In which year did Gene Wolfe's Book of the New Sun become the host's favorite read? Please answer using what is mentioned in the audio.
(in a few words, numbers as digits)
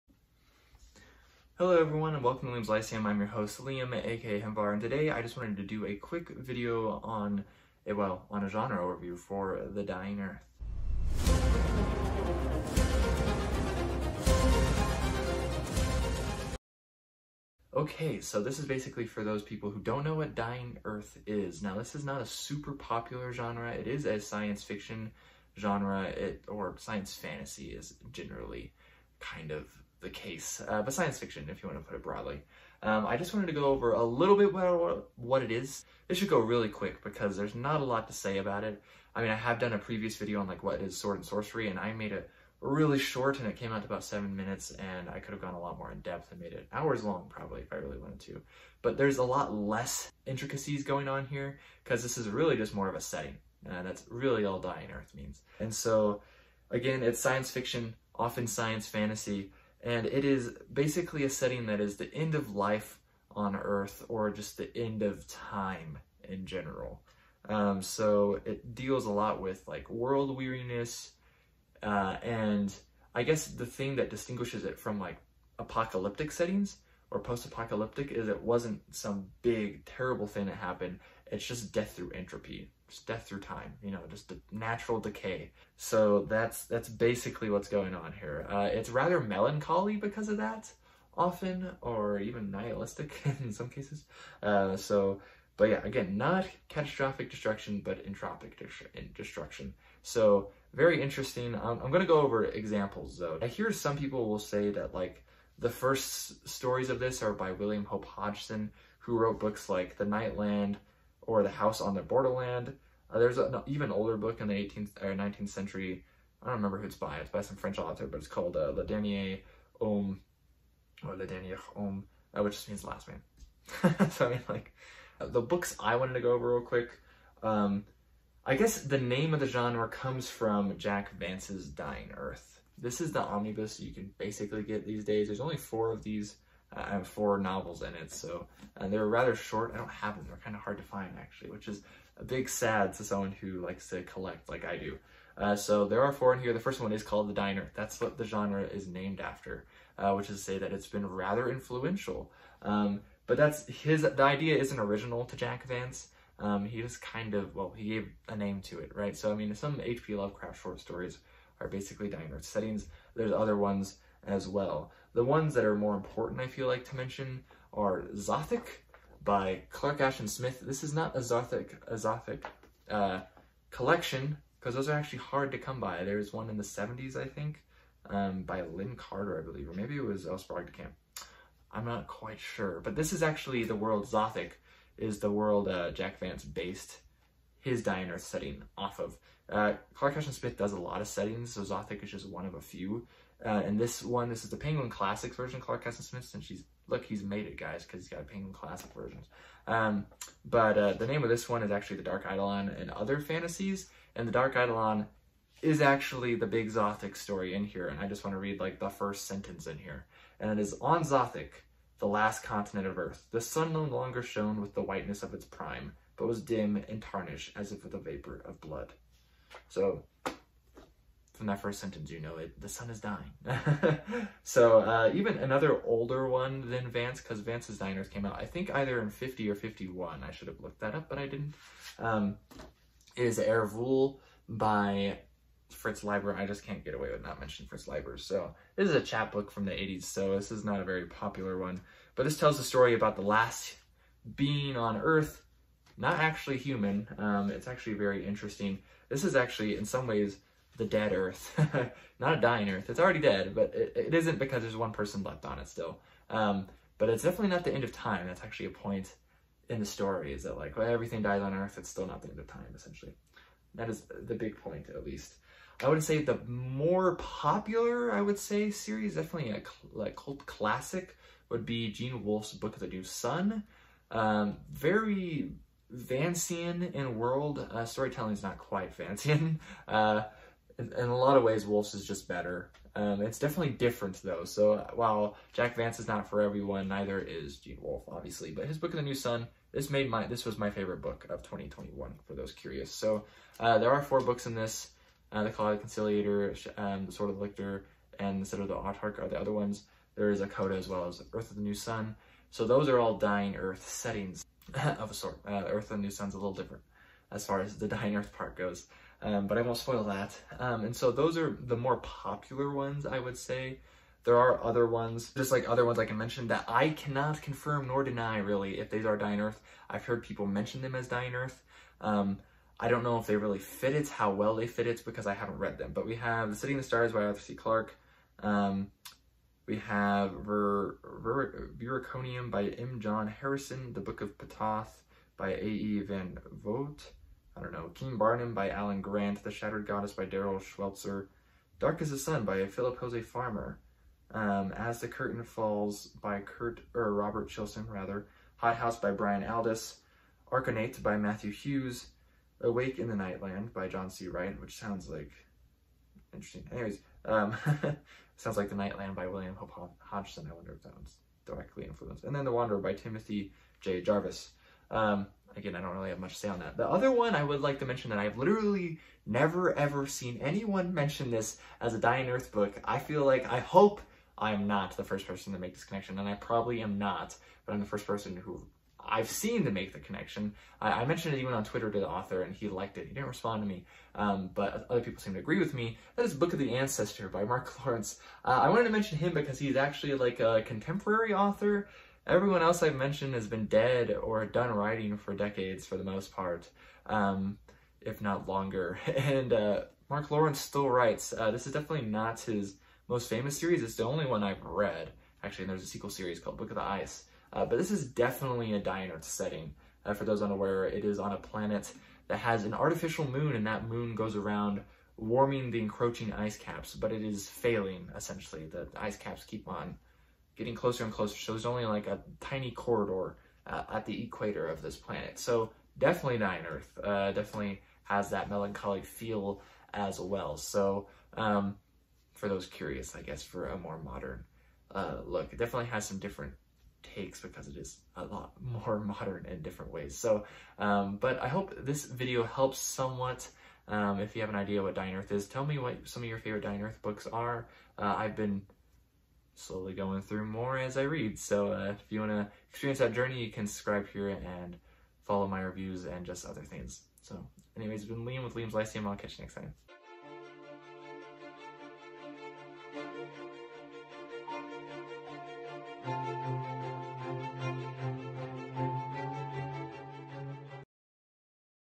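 2021.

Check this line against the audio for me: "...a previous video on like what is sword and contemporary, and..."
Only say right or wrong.
wrong.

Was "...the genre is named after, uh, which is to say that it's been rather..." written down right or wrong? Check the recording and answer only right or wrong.
right.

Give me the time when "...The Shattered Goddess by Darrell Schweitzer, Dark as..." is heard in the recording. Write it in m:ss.
5:39.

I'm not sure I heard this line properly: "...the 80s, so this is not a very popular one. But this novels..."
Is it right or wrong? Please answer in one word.
wrong.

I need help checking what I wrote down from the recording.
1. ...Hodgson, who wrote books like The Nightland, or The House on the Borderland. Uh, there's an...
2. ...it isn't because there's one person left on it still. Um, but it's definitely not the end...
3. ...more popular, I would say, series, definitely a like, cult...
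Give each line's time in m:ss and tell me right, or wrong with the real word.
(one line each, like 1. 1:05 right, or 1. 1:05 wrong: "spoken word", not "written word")
1. 1:48 right
2. 4:13 right
3. 4:26 right.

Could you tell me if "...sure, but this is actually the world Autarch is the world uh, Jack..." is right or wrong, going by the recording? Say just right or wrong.
wrong.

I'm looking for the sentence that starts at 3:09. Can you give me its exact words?
Uh, Clark Smith does a lot of settings, so Zothique is just one of a few.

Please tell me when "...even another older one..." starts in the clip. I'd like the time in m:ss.
3:45.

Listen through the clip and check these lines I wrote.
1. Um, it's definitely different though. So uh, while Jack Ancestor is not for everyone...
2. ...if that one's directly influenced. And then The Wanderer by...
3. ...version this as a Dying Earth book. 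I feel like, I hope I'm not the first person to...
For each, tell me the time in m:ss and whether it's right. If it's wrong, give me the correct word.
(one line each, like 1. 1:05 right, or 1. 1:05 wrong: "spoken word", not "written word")
1. 4:42 wrong: "Vance", not "Ancestor"
2. 6:00 right
3. 6:10 wrong: "mention", not "version".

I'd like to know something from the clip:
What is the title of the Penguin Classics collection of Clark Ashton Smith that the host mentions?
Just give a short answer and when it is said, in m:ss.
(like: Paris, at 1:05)
The Dark Eidolon and Other Fantasies, at 3:21.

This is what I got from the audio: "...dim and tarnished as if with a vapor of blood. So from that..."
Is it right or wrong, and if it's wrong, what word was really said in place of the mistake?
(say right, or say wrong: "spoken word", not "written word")
right.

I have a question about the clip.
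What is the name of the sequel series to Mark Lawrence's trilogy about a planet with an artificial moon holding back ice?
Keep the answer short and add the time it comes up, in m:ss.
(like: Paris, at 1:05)
Book of the Ice, at 6:46.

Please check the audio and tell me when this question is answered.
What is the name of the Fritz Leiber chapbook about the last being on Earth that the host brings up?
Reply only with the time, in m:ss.
3:53.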